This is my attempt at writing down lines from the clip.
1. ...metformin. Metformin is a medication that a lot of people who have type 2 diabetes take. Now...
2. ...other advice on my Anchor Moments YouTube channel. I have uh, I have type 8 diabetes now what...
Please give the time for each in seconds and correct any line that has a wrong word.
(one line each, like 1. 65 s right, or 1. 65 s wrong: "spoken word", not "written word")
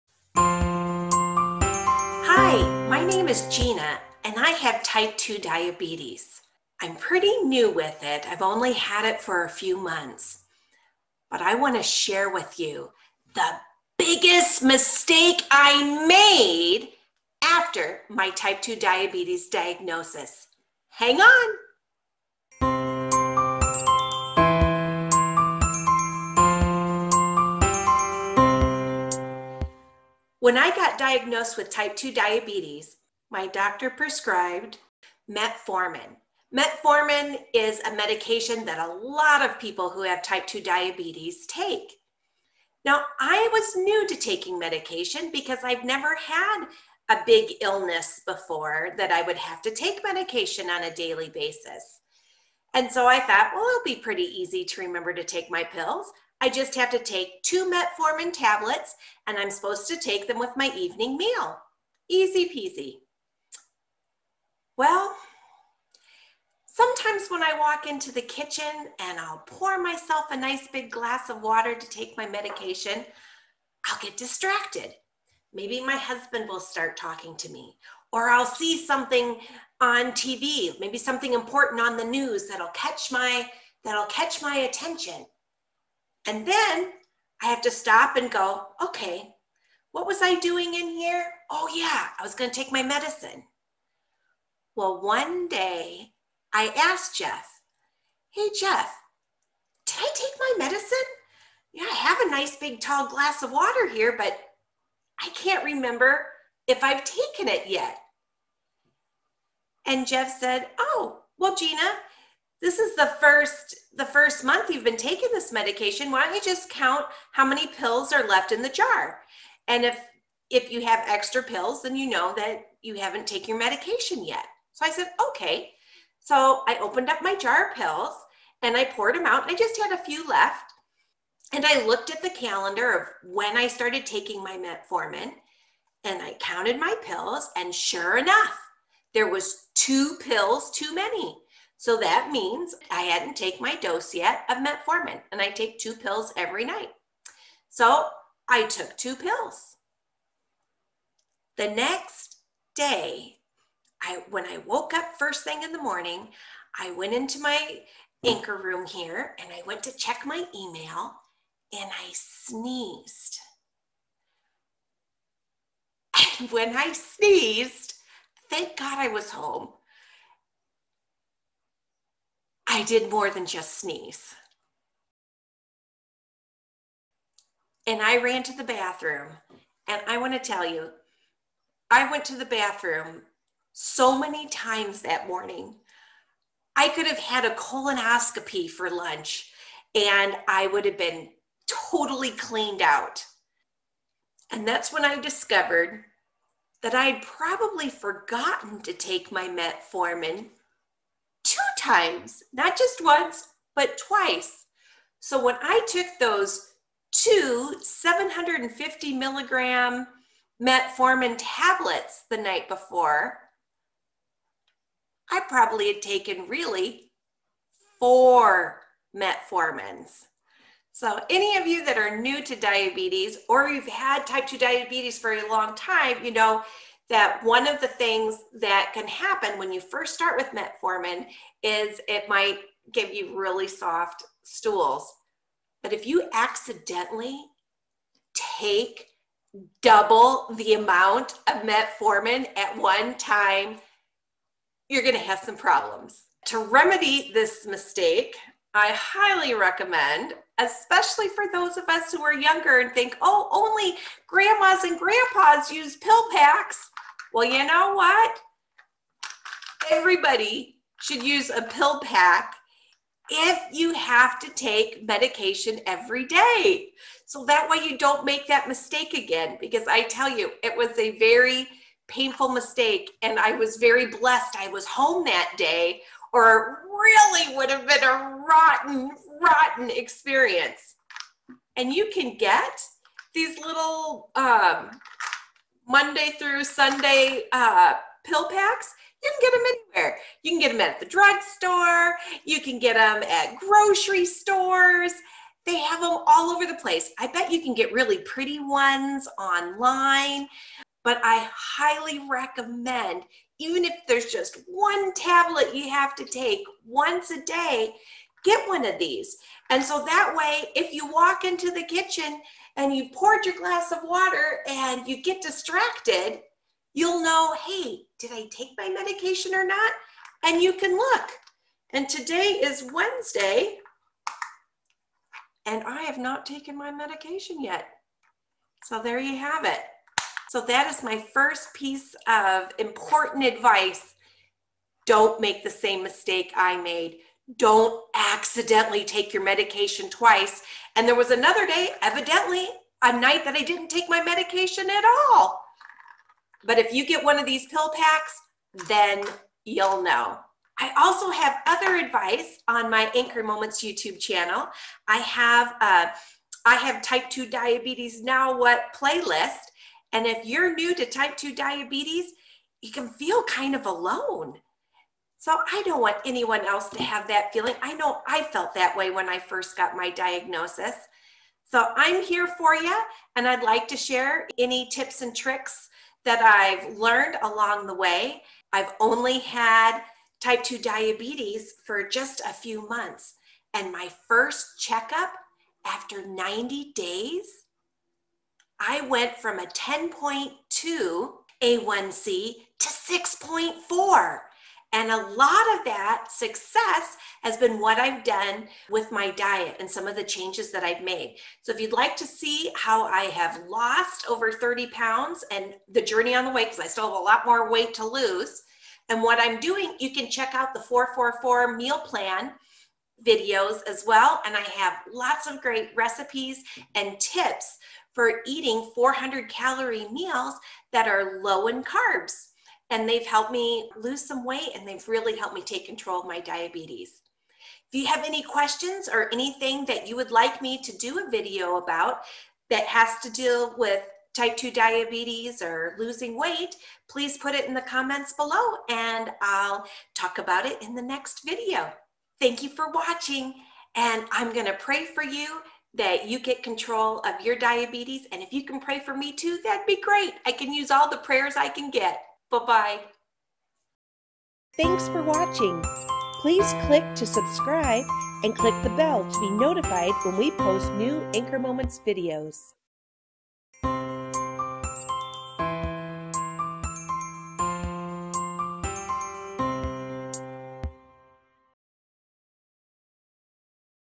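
1. 35 s right
2. 351 s wrong: "2", not "8".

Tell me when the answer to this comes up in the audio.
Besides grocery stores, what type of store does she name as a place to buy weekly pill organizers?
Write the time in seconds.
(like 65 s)
291 s.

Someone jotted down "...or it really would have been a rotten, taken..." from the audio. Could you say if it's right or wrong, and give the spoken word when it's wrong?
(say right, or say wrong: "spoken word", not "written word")
wrong: "rotten", not "taken".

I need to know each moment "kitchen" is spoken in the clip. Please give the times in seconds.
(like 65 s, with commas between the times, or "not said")
68 s, 311 s.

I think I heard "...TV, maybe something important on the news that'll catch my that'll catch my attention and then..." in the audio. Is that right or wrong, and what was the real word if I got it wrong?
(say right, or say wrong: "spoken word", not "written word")
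right.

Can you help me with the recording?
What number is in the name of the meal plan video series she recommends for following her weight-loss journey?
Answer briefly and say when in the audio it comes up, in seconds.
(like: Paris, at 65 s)
444, at 410 s.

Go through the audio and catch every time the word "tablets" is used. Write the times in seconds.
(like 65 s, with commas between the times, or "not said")
58 s, 211 s, 305 s.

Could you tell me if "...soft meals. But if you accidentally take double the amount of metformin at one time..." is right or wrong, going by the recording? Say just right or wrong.
wrong.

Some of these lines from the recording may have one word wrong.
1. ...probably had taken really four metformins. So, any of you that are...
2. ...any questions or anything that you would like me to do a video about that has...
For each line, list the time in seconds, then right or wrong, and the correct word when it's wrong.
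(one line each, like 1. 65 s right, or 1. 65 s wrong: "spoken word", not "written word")
1. 215 s right
2. 428 s right.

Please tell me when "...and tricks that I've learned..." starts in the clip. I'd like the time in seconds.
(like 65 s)
375 s.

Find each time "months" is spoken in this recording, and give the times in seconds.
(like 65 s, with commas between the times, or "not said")
9 s, 114 s, 382 s.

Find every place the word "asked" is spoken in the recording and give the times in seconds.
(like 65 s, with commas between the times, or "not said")
96 s.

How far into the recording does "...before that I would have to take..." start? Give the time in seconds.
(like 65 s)
48 s.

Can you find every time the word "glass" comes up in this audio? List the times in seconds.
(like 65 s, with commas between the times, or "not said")
70 s, 103 s, 313 s.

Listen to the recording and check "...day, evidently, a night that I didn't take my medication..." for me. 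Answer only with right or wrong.
right.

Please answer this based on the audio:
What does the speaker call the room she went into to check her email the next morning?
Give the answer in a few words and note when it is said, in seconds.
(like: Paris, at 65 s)
anchor room, at 158 s.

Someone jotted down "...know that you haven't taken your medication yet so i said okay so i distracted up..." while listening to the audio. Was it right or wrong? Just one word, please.
wrong.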